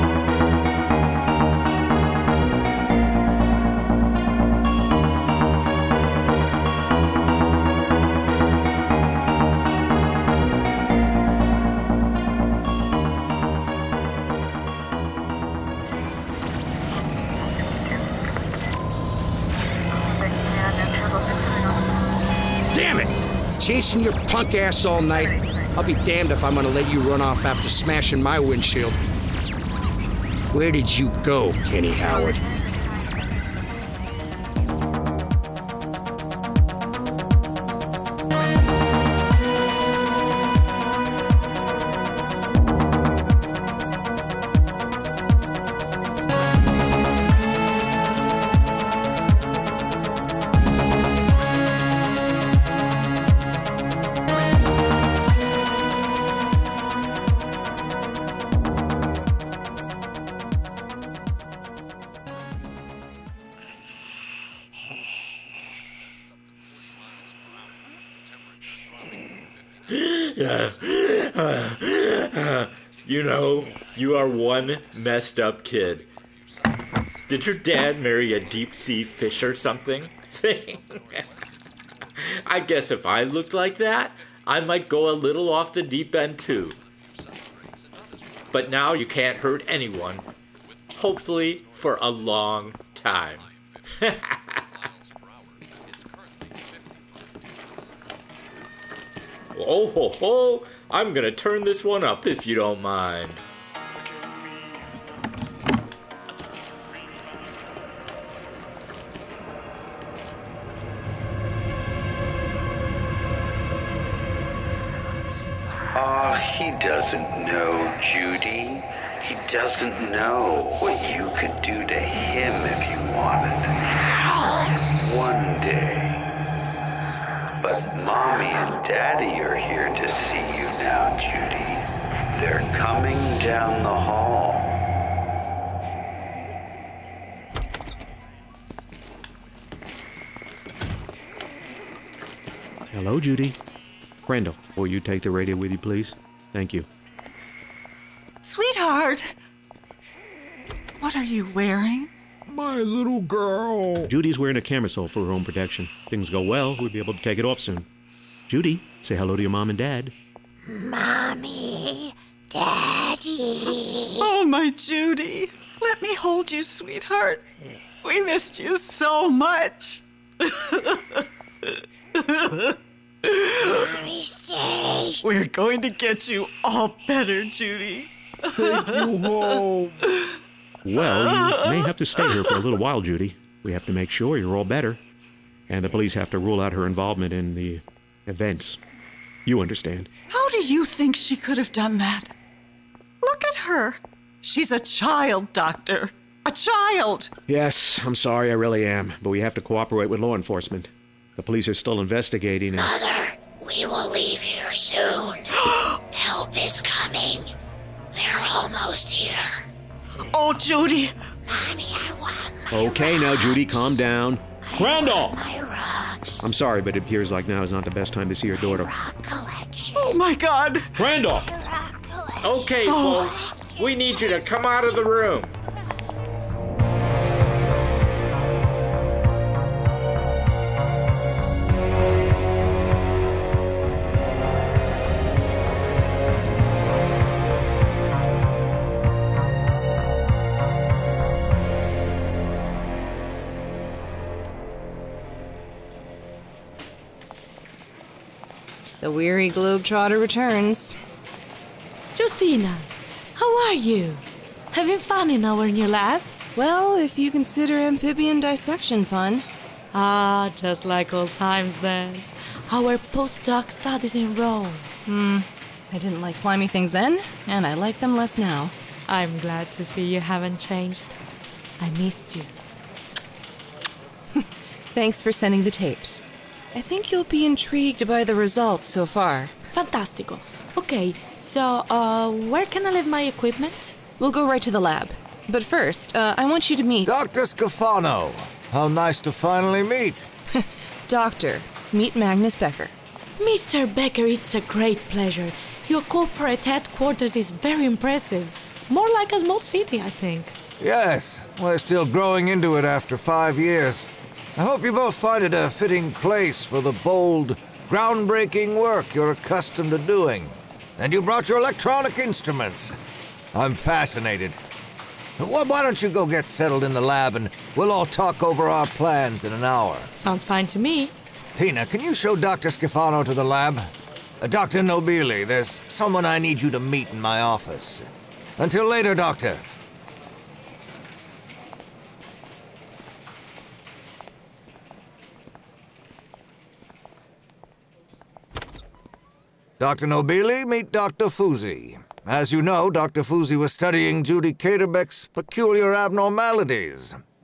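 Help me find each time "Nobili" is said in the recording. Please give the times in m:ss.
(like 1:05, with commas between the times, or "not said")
5:24, 5:40.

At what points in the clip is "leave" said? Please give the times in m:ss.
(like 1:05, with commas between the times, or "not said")
3:24, 4:42.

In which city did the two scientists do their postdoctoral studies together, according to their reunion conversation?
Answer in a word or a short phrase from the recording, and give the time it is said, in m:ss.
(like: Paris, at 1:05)
Rome, at 4:24.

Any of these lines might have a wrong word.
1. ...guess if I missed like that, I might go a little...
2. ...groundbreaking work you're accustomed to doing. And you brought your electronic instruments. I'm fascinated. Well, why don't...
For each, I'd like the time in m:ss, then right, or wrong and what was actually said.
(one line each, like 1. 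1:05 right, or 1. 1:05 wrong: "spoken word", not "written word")
1. 1:22 wrong: "looked", not "missed"
2. 5:07 right.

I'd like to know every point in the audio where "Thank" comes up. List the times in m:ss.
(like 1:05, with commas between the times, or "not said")
2:26, 4:34.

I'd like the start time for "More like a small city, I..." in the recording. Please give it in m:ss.
4:58.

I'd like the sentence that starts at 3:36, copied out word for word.
I'm sorry, but it appears like now is not the best time to see your daughter.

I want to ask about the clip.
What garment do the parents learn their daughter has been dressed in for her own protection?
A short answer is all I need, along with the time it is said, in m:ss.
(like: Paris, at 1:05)
camisole, at 2:34.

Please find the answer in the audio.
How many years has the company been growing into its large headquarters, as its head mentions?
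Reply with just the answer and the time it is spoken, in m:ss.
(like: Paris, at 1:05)
5, at 5:03.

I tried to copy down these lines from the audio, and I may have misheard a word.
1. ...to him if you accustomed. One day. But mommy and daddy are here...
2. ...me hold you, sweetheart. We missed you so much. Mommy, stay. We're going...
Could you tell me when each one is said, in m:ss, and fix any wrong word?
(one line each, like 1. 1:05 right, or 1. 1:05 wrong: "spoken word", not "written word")
1. 2:01 wrong: "wanted", not "accustomed"
2. 2:46 right.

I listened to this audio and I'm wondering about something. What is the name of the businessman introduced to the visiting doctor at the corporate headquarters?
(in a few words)
Magnus Becker.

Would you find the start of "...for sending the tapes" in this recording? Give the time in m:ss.
4:35.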